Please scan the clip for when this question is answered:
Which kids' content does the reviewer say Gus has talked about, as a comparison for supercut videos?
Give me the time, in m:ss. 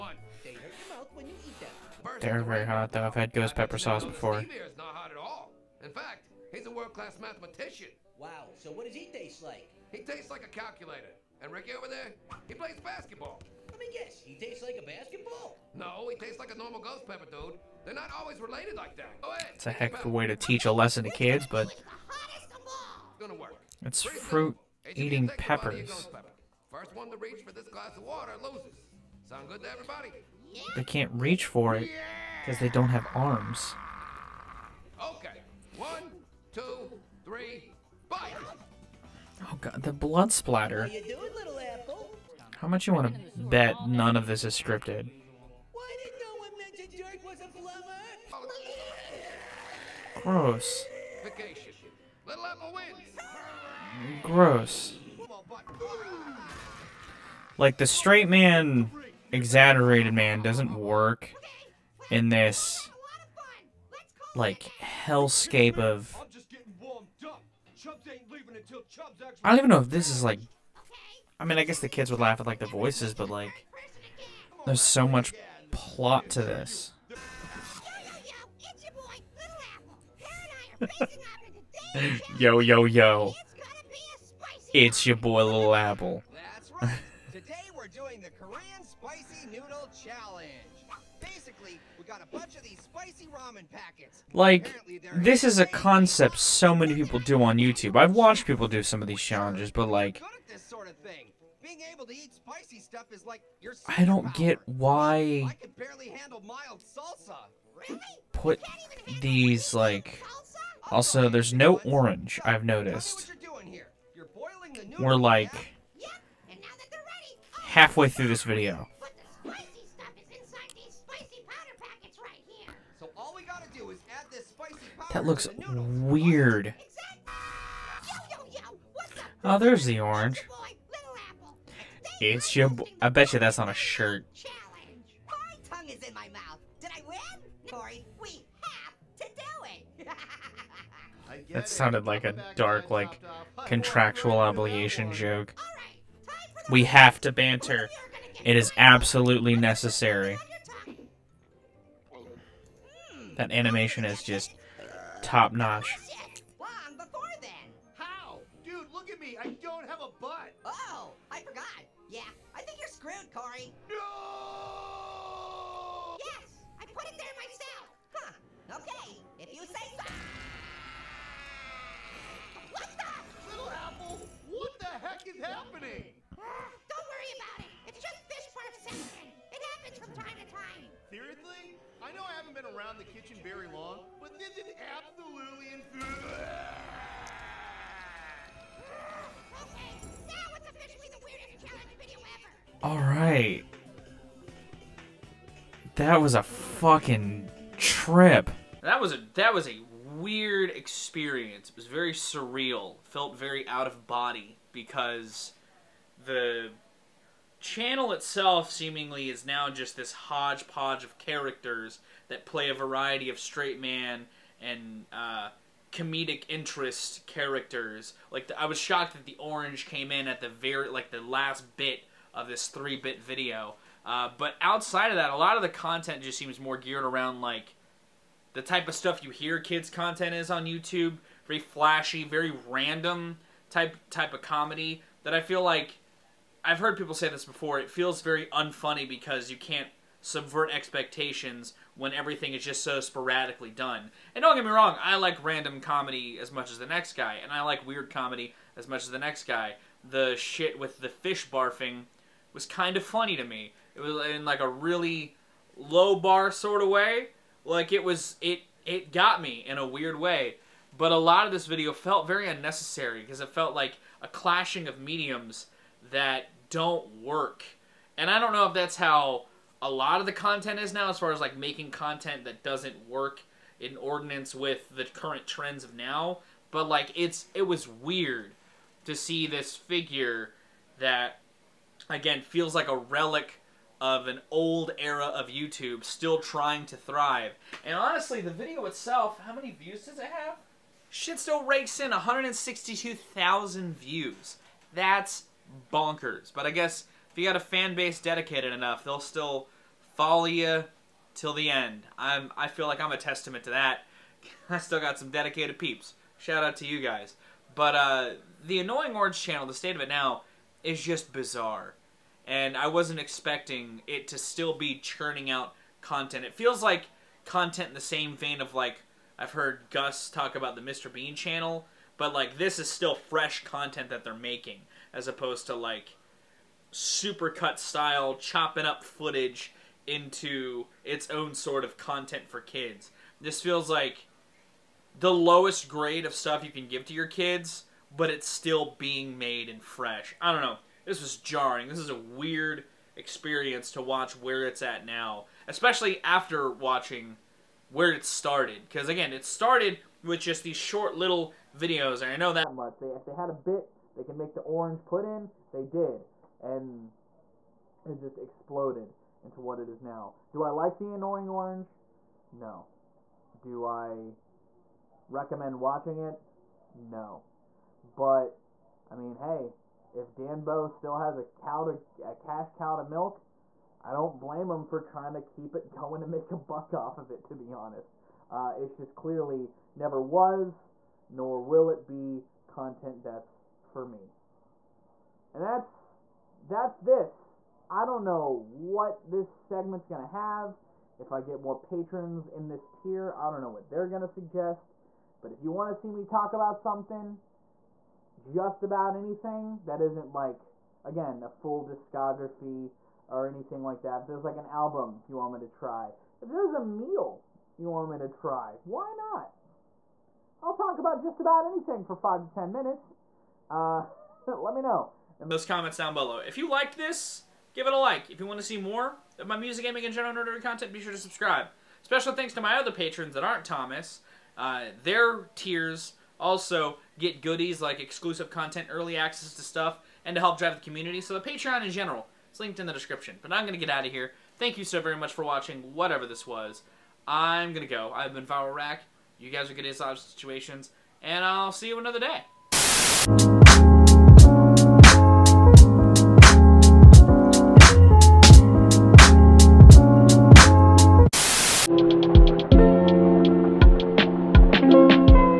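5:20.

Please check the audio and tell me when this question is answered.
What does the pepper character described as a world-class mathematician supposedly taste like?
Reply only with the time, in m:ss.
0:09.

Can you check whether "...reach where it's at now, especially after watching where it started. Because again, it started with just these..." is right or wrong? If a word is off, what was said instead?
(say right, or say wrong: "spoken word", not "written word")
wrong: "watch", not "reach".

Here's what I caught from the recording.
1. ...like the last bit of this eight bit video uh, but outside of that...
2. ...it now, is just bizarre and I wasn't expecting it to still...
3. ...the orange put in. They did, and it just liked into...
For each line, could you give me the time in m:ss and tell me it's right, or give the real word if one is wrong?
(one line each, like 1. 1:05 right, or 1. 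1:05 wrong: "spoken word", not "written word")
1. 3:40 wrong: "three", not "eight"
2. 5:10 right
3. 5:54 wrong: "exploded", not "liked".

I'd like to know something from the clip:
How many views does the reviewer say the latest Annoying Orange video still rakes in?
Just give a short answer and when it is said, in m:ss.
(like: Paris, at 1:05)
162,000, at 4:52.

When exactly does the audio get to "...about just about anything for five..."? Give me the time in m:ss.
6:50.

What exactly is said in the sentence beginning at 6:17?
To be honest, uh, it's just clearly never was, nor will it be content that's for me.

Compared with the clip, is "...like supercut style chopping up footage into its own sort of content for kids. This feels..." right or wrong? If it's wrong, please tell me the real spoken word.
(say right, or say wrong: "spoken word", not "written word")
right.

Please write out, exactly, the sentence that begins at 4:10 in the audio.
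The shit with the fish barfing was kind of funny to me.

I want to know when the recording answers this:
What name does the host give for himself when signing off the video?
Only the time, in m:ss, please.
7:18.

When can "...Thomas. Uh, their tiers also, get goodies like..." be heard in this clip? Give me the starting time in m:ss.
7:03.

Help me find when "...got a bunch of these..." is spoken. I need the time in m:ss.
1:32.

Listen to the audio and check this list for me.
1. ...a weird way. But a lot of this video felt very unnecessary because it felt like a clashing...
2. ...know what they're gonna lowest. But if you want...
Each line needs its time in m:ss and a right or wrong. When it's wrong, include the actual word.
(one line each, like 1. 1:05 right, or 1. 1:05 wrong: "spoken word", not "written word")
1. 4:19 right
2. 6:33 wrong: "suggest", not "lowest".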